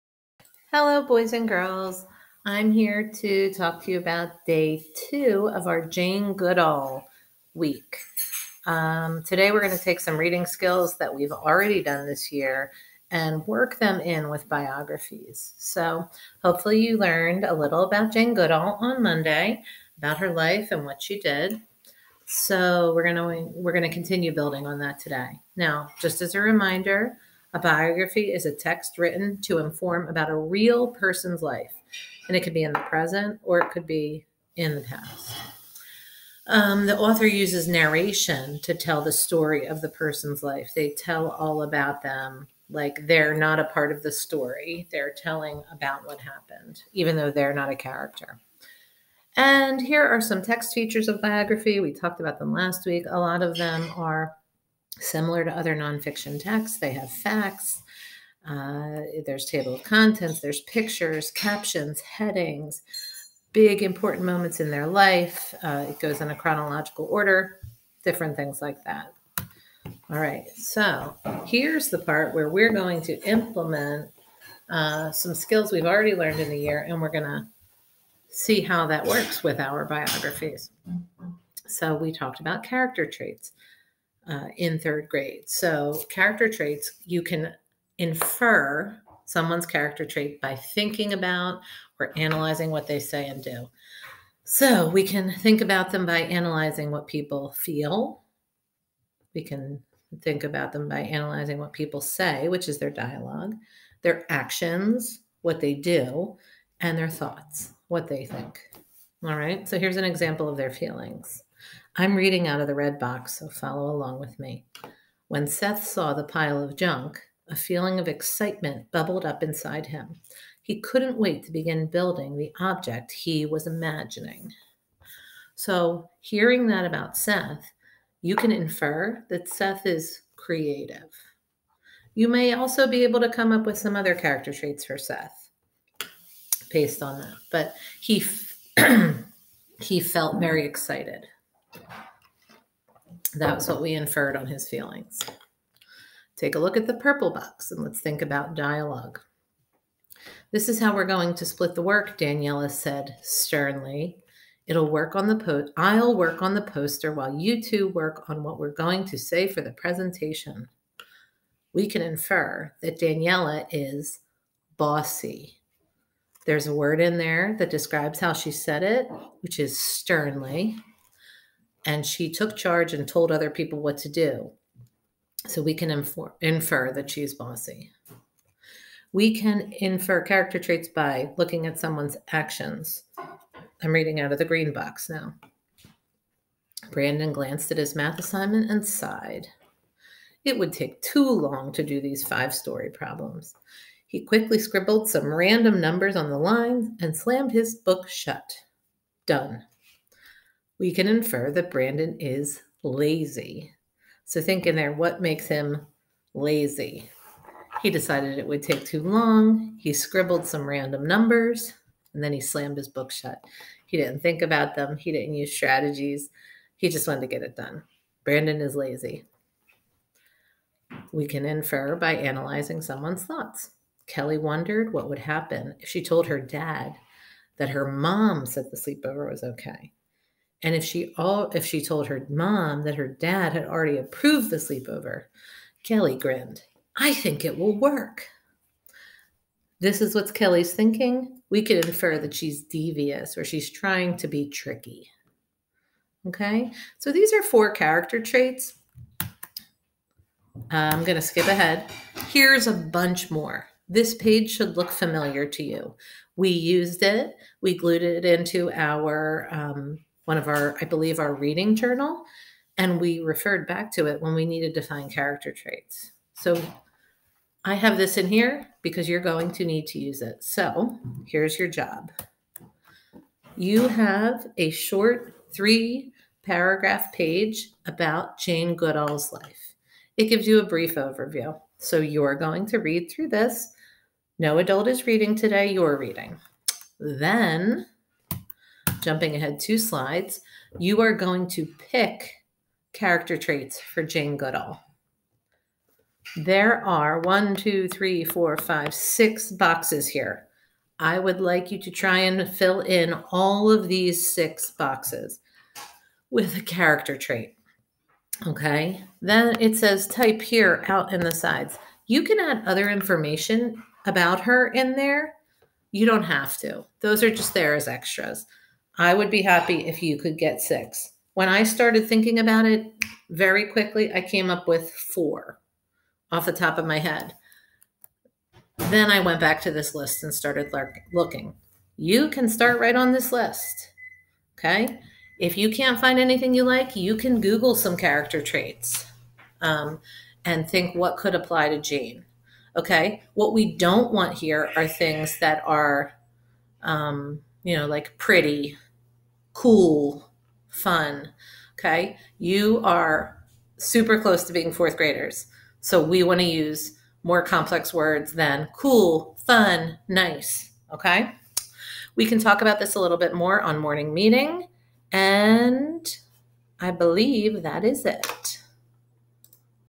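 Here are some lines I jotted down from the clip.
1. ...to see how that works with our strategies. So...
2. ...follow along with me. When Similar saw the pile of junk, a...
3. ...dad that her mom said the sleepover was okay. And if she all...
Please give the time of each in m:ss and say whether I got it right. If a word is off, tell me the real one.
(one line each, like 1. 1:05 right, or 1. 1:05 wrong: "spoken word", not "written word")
1. 1:17 wrong: "biographies", not "strategies"
2. 1:53 wrong: "Seth", not "Similar"
3. 3:46 right.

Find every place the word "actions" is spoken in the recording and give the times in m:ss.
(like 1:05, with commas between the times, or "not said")
1:44, 3:02.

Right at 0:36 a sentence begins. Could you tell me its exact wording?
Um, the author uses narration to tell the story of the person's life.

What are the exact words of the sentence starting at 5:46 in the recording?
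Um, you know, like pretty, cool, fun.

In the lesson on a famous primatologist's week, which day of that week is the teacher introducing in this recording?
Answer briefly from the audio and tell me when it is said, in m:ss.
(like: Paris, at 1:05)
Day two, at 0:04.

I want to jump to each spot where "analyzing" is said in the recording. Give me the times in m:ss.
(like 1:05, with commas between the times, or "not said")
1:32, 1:36, 1:40, 3:42.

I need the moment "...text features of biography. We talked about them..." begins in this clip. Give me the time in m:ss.
0:50.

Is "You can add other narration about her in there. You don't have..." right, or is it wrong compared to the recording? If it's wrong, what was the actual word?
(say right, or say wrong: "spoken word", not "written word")
wrong: "information", not "narration".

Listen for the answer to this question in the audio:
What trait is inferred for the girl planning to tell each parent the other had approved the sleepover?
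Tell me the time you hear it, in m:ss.
4:02.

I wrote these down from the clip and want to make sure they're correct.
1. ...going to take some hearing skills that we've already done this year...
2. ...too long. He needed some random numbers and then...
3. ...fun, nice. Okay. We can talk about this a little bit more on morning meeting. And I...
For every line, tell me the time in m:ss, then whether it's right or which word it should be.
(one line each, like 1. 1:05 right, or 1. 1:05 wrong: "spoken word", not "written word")
1. 0:09 wrong: "reading", not "hearing"
2. 3:28 wrong: "scribbled", not "needed"
3. 5:59 right.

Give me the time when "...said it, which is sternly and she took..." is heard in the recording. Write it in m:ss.
2:48.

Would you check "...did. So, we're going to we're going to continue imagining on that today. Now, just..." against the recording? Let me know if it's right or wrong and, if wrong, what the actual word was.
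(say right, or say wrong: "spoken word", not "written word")
wrong: "building", not "imagining".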